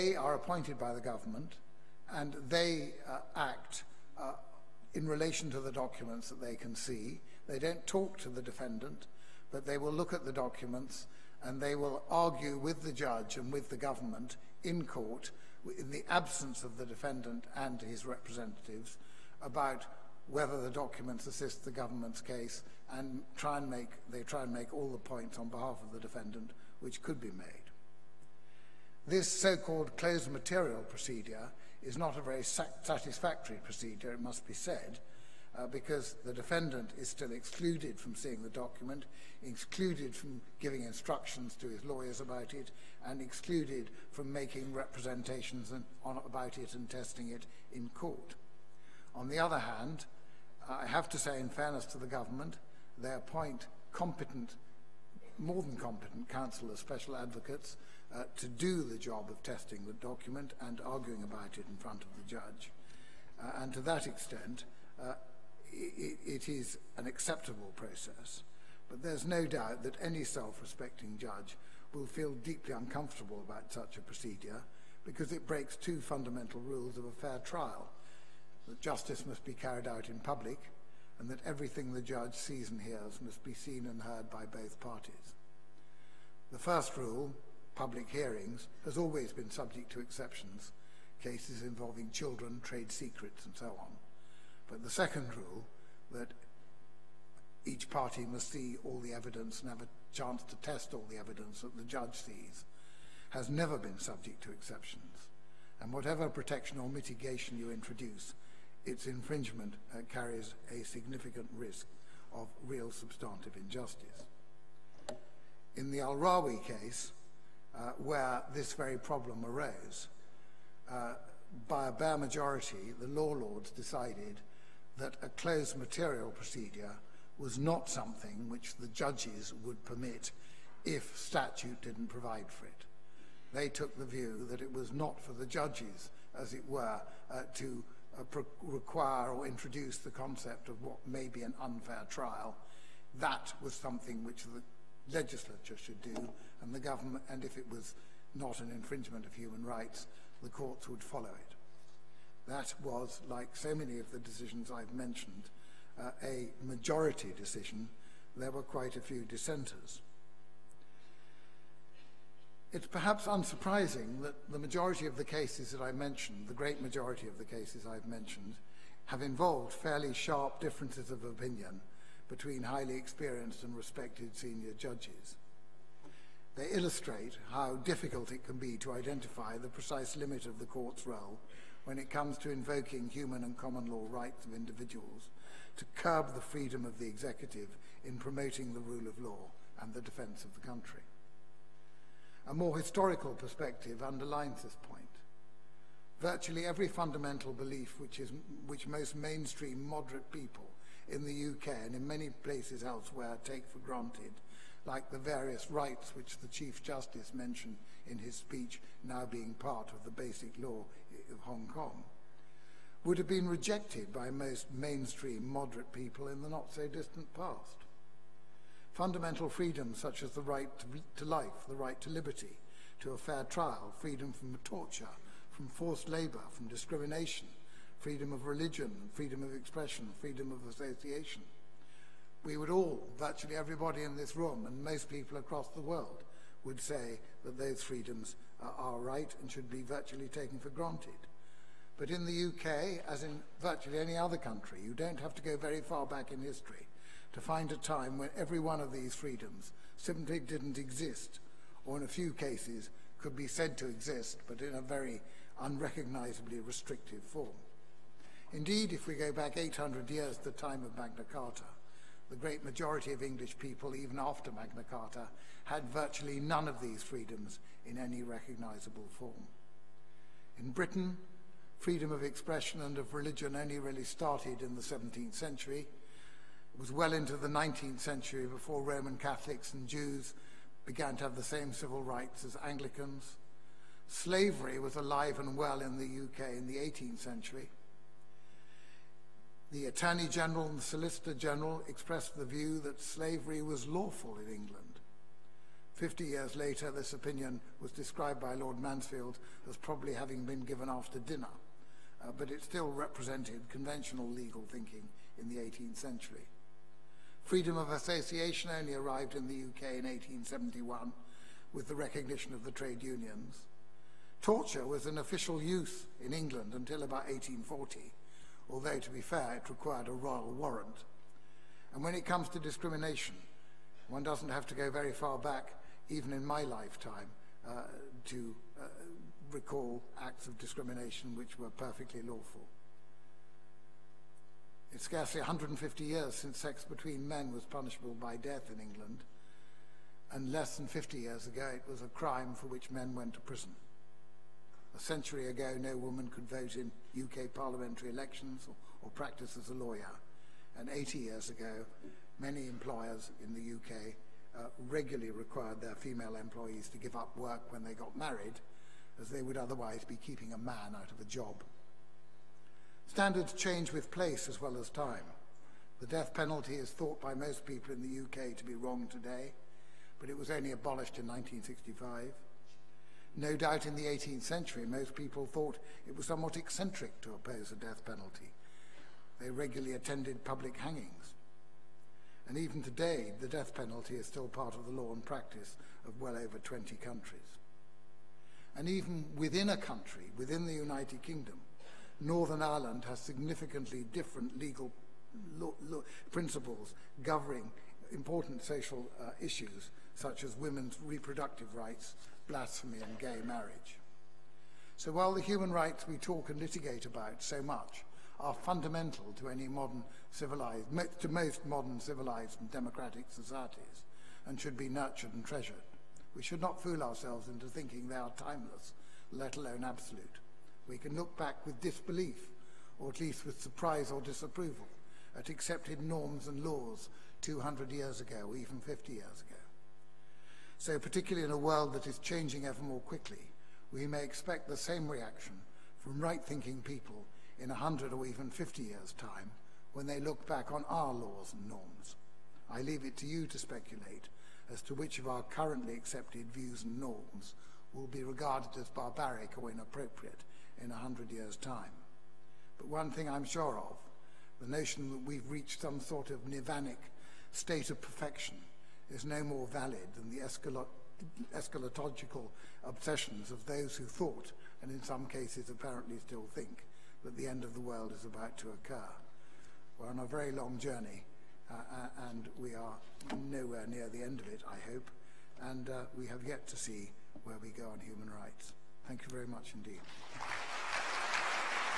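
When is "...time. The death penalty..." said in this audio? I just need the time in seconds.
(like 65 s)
364 s.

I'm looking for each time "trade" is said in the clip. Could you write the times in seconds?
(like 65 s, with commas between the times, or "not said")
92 s, 312 s.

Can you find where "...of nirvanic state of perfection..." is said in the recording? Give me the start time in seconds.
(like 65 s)
456 s.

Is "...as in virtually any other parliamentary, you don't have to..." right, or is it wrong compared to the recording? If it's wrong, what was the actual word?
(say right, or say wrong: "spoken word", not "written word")
wrong: "country", not "parliamentary".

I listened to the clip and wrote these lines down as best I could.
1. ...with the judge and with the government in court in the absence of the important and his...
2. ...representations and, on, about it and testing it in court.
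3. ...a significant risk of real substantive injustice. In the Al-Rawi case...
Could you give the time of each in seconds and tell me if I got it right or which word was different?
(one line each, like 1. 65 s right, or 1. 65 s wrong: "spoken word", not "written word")
1. 12 s wrong: "defendant", not "important"
2. 44 s right
3. 110 s right.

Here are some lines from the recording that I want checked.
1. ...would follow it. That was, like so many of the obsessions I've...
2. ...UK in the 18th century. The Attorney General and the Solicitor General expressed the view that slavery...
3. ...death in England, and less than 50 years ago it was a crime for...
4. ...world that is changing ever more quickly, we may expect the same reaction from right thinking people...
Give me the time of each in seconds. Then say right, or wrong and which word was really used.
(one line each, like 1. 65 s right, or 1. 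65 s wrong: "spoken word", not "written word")
1. 150 s wrong: "decisions", not "obsessions"
2. 286 s right
3. 338 s right
4. 431 s right.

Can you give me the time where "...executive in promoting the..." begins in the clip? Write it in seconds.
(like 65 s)
187 s.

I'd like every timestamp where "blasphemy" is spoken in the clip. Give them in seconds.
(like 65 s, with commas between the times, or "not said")
402 s.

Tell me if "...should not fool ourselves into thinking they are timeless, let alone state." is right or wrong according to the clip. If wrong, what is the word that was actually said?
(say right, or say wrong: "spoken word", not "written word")
wrong: "absolute", not "state".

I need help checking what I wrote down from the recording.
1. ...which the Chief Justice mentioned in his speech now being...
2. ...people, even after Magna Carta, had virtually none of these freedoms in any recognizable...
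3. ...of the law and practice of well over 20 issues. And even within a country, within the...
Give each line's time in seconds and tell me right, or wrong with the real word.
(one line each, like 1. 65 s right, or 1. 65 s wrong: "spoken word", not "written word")
1. 206 s right
2. 263 s right
3. 384 s wrong: "countries", not "issues".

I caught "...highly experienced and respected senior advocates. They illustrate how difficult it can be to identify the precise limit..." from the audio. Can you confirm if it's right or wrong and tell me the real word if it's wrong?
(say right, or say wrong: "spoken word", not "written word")
wrong: "judges", not "advocates".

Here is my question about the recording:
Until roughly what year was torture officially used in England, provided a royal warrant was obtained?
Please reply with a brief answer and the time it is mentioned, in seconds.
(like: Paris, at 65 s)
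1840, at 317 s.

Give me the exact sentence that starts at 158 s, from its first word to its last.
There were quite a few dissenters.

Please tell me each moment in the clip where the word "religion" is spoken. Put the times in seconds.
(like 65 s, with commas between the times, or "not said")
228 s, 273 s.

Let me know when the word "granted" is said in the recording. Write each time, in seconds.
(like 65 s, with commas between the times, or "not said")
203 s, 240 s.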